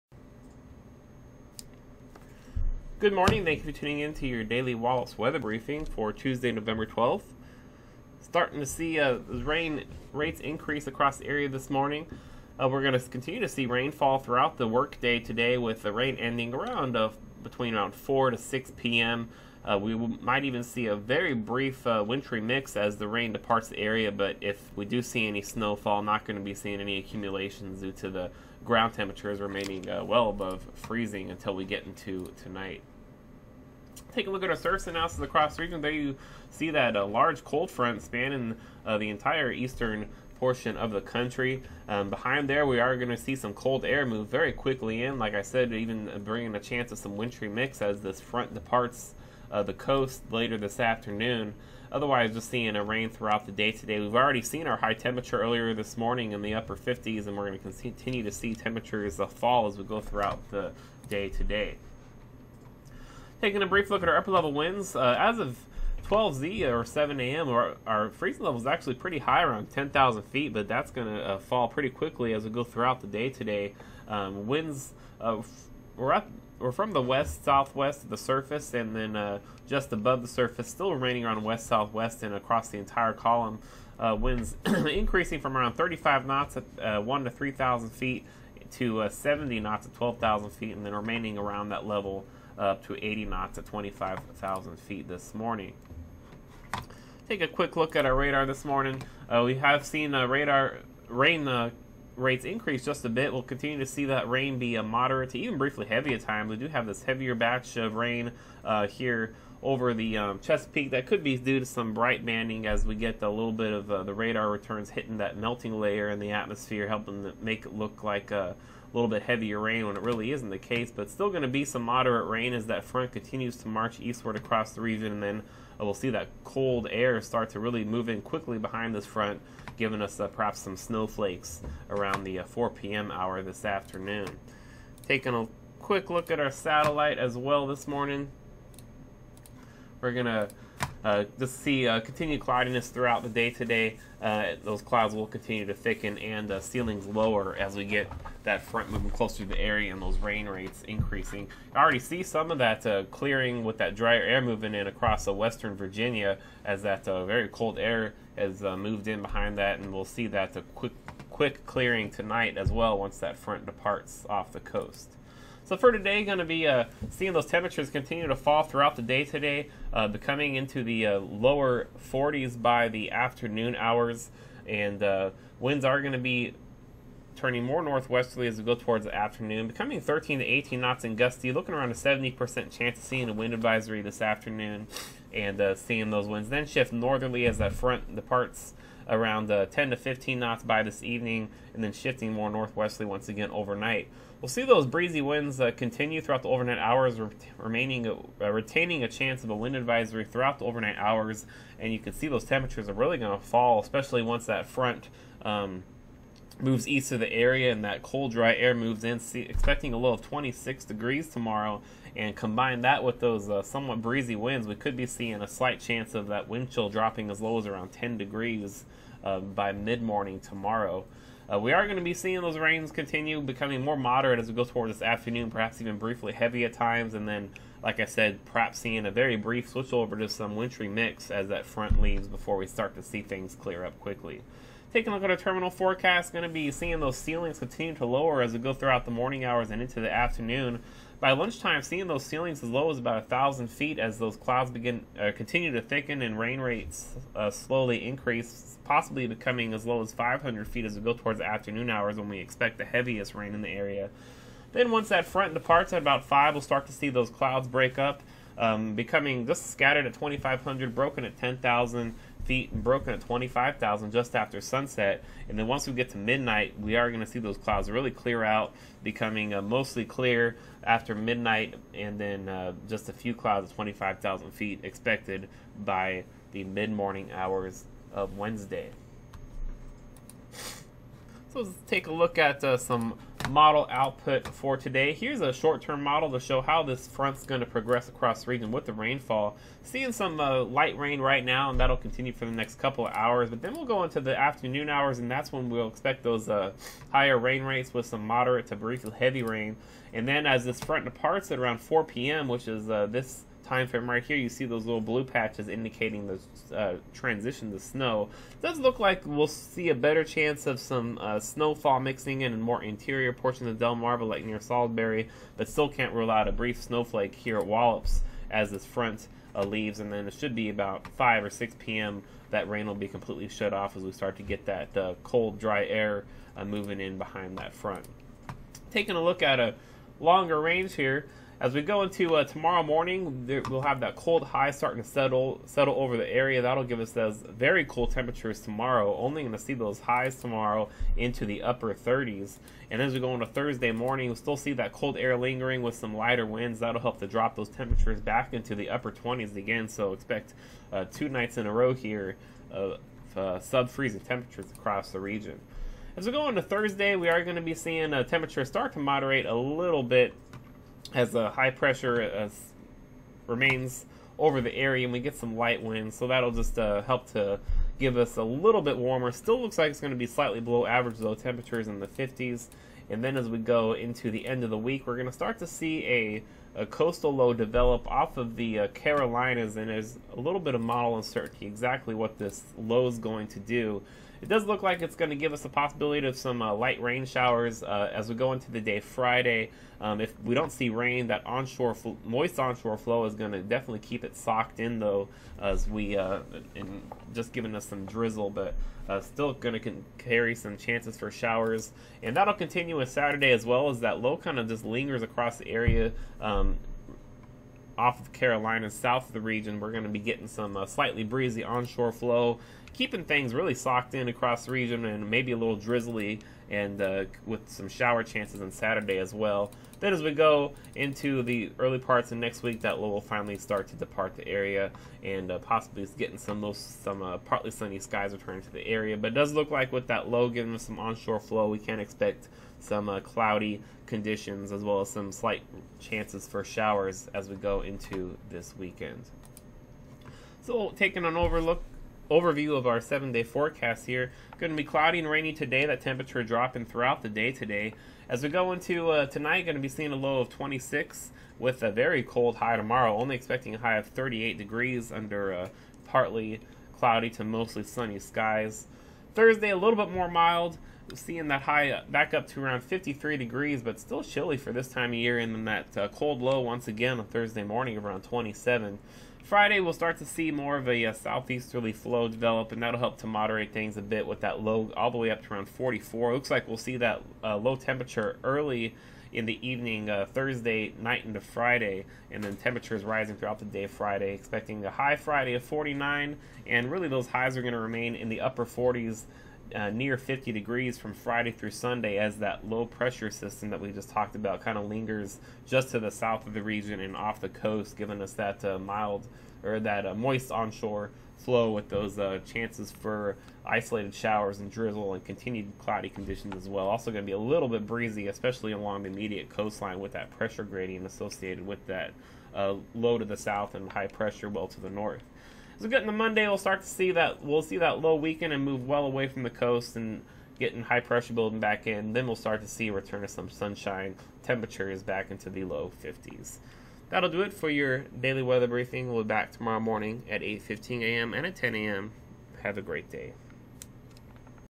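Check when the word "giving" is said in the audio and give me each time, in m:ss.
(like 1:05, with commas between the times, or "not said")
2:09, 6:37, 7:10, 8:17.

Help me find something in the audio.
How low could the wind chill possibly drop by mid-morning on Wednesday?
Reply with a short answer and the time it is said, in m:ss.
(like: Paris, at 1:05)
10 degrees, at 3:37.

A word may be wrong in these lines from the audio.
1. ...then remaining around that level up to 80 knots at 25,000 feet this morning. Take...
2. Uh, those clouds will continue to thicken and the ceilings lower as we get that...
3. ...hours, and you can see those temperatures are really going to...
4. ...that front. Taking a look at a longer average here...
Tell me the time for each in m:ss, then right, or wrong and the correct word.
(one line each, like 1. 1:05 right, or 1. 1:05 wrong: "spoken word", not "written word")
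1. 1:30 right
2. 2:24 right
3. 3:20 right
4. 5:27 wrong: "range", not "average".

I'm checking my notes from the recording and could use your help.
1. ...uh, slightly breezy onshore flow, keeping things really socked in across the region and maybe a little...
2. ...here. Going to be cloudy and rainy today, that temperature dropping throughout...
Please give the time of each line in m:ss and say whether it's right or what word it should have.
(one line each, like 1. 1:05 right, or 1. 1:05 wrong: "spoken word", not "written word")
1. 6:50 right
2. 7:24 right.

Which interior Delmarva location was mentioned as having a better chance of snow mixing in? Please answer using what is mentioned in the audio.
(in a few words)
Salisbury.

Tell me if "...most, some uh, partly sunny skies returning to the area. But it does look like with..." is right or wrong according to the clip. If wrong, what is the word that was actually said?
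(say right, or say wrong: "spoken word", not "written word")
right.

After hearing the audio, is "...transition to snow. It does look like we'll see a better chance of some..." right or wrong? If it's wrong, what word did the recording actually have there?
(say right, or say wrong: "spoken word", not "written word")
right.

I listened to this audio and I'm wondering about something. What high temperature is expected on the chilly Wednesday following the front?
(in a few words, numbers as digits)
38 degrees.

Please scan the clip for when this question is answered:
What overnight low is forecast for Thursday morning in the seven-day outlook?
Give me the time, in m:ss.
7:48.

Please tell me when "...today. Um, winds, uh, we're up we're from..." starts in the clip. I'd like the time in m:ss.
1:13.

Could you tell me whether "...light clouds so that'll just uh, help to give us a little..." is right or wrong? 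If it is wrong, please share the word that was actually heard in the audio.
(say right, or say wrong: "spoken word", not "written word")
wrong: "winds", not "clouds".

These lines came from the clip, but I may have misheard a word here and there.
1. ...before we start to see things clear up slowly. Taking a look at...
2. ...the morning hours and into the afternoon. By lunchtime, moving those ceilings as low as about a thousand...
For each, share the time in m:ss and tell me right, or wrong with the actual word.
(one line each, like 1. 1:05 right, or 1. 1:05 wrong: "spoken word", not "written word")
1. 3:52 wrong: "quickly", not "slowly"
2. 3:59 wrong: "seeing", not "moving".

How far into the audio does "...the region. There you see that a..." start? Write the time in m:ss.
0:35.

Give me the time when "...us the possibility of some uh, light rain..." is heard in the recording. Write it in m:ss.
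6:25.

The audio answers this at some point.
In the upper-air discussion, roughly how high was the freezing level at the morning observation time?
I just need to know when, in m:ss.
1:09.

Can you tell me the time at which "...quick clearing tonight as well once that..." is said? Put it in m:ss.
2:41.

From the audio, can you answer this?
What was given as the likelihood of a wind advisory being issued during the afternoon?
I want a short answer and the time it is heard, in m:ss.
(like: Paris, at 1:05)
70%, at 3:01.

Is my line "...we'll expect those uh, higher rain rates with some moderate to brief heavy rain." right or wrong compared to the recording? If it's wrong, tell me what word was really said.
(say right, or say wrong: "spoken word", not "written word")
right.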